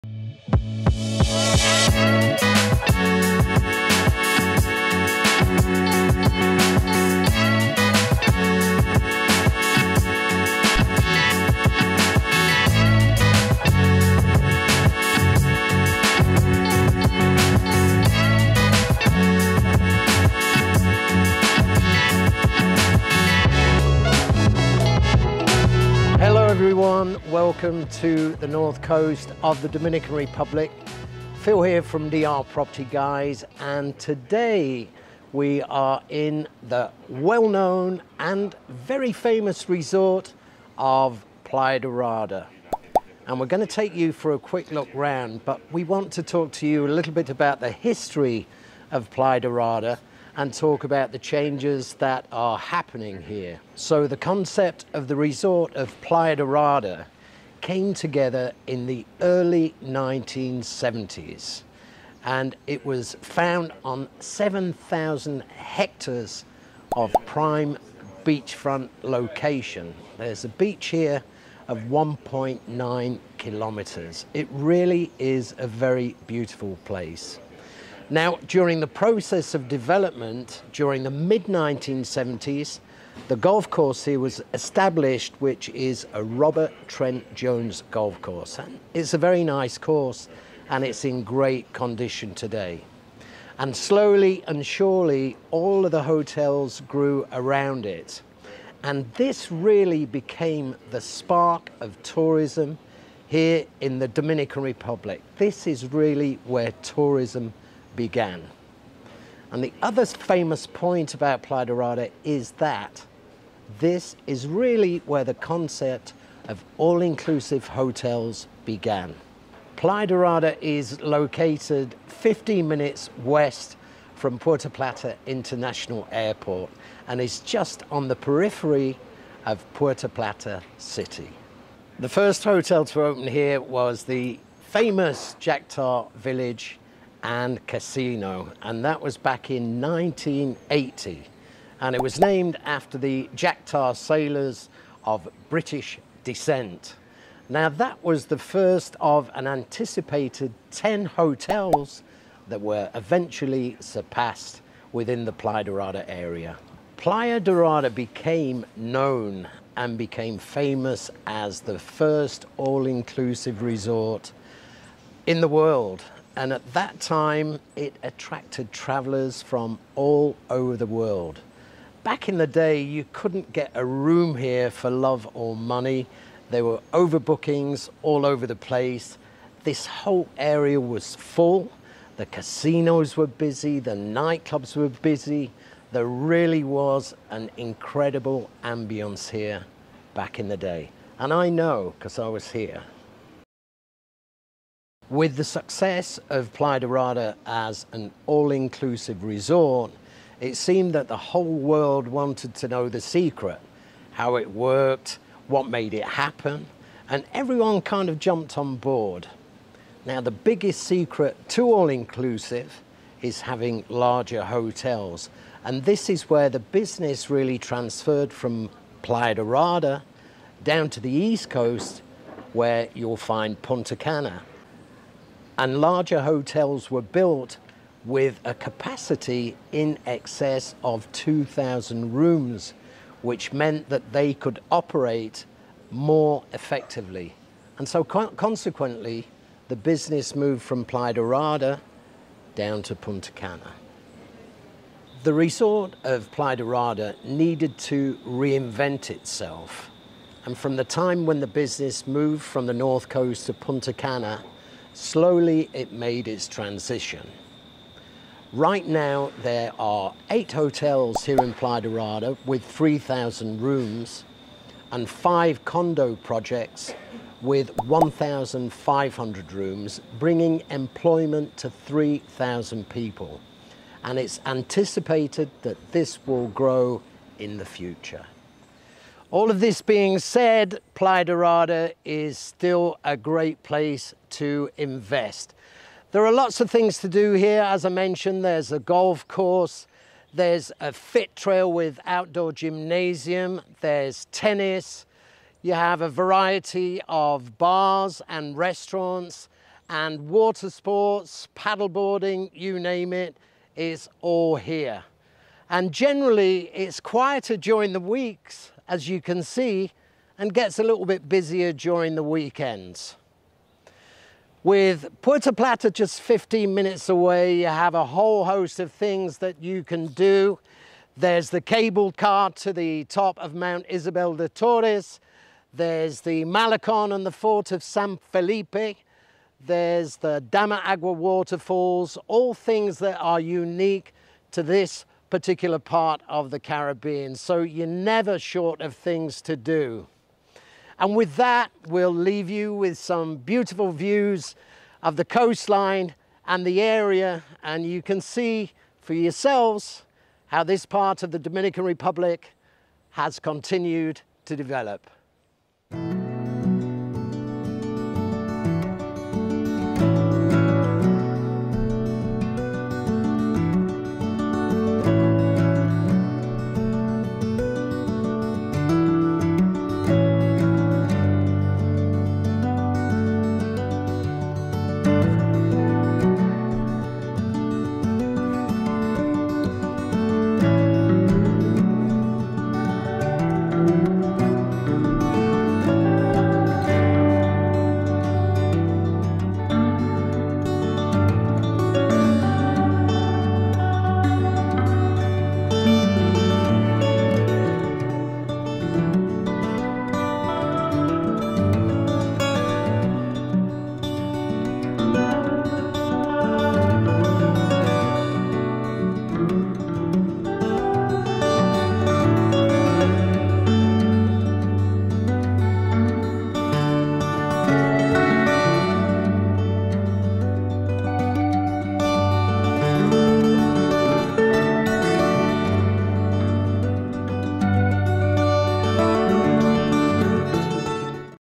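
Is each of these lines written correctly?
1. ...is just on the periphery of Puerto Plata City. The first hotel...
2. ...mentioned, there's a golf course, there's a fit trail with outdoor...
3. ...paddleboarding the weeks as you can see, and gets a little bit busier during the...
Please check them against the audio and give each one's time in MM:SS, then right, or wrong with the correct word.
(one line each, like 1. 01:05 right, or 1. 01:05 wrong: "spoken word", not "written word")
1. 02:07 right
2. 04:47 right
3. 05:07 wrong: "during", not "paddleboarding".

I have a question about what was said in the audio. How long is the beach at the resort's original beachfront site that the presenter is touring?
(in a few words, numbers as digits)
1.9 kilometers.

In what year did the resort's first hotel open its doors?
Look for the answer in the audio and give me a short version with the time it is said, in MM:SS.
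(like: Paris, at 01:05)
1980, at 02:19.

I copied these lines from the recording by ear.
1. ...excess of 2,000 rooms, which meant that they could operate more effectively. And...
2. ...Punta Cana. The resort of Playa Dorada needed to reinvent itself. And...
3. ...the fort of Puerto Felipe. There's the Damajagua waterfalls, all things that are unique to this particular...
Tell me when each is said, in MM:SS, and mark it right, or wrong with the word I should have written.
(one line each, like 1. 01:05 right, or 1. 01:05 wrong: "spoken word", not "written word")
1. 03:50 right
2. 04:02 right
3. 05:27 wrong: "San", not "Puerto".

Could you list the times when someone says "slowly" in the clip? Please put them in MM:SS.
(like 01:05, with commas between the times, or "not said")
01:33, 04:14.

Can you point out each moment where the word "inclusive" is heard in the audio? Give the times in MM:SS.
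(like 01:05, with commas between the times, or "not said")
01:56, 02:42, 03:18, 03:31.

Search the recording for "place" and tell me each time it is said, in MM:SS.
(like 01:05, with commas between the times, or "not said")
01:16, 02:58, 04:43.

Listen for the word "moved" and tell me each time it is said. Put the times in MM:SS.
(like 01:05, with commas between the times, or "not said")
04:00, 04:12.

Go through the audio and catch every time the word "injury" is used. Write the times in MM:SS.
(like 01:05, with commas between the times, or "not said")
not said.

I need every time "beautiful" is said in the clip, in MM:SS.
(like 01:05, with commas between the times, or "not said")
01:16, 05:43.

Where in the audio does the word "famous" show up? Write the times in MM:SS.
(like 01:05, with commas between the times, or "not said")
00:39, 01:50, 02:14, 02:40.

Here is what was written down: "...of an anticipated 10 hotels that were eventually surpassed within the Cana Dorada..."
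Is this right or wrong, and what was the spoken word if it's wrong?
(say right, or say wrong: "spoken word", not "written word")
wrong: "Playa", not "Cana".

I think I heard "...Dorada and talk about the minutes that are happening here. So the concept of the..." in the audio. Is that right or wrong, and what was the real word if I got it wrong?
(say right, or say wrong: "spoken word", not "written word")
wrong: "changes", not "minutes".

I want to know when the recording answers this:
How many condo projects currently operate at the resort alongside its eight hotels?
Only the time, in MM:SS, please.
04:25.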